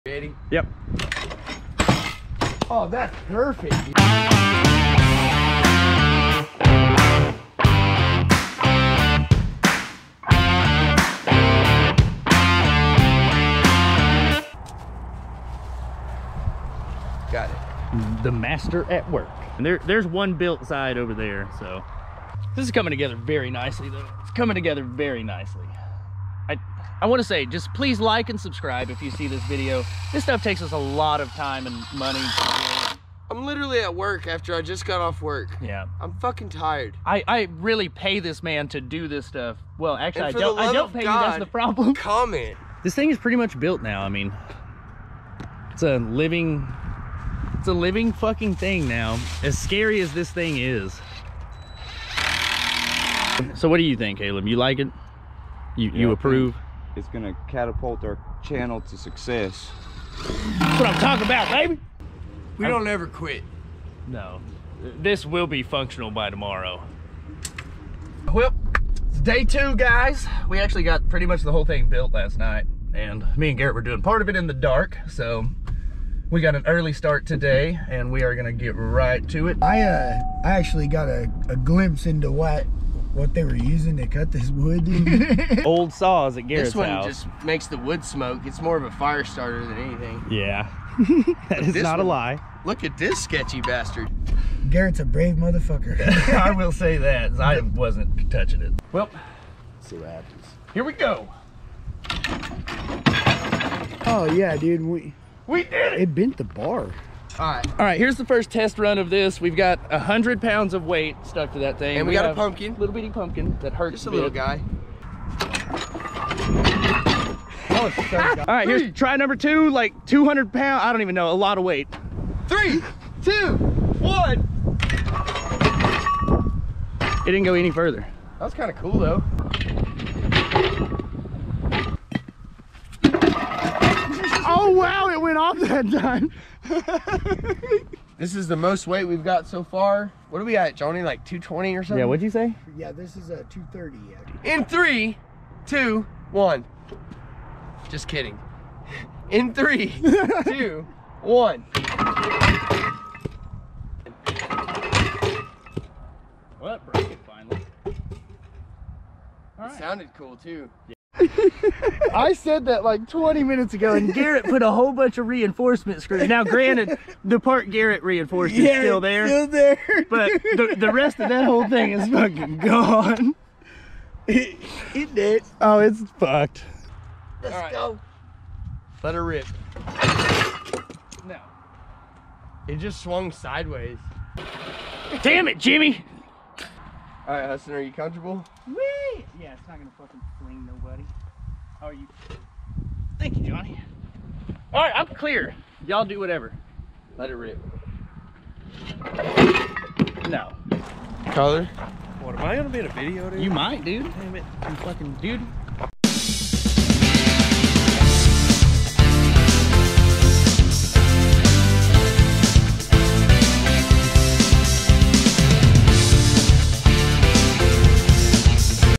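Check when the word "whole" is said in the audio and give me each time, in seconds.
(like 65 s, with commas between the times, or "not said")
71 s, 164 s, 171 s.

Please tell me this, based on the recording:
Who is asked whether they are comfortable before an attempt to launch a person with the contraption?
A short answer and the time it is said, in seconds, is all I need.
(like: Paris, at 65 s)
Hudson, at 187 s.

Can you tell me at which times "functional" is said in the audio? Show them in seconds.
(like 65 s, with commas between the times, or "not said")
65 s.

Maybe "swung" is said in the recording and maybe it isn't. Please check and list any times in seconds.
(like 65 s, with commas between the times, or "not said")
183 s.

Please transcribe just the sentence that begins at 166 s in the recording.
Now, granted, the part Garrett reinforced is still there.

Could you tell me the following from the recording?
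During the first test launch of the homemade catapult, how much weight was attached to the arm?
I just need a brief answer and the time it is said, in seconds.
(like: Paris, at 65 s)
100 pounds, at 109 s.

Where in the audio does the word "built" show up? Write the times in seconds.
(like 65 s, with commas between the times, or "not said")
20 s, 43 s, 71 s.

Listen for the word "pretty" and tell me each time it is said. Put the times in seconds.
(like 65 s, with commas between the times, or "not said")
43 s, 71 s.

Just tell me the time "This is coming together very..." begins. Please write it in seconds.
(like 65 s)
22 s.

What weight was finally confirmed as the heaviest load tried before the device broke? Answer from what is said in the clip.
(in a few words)
230.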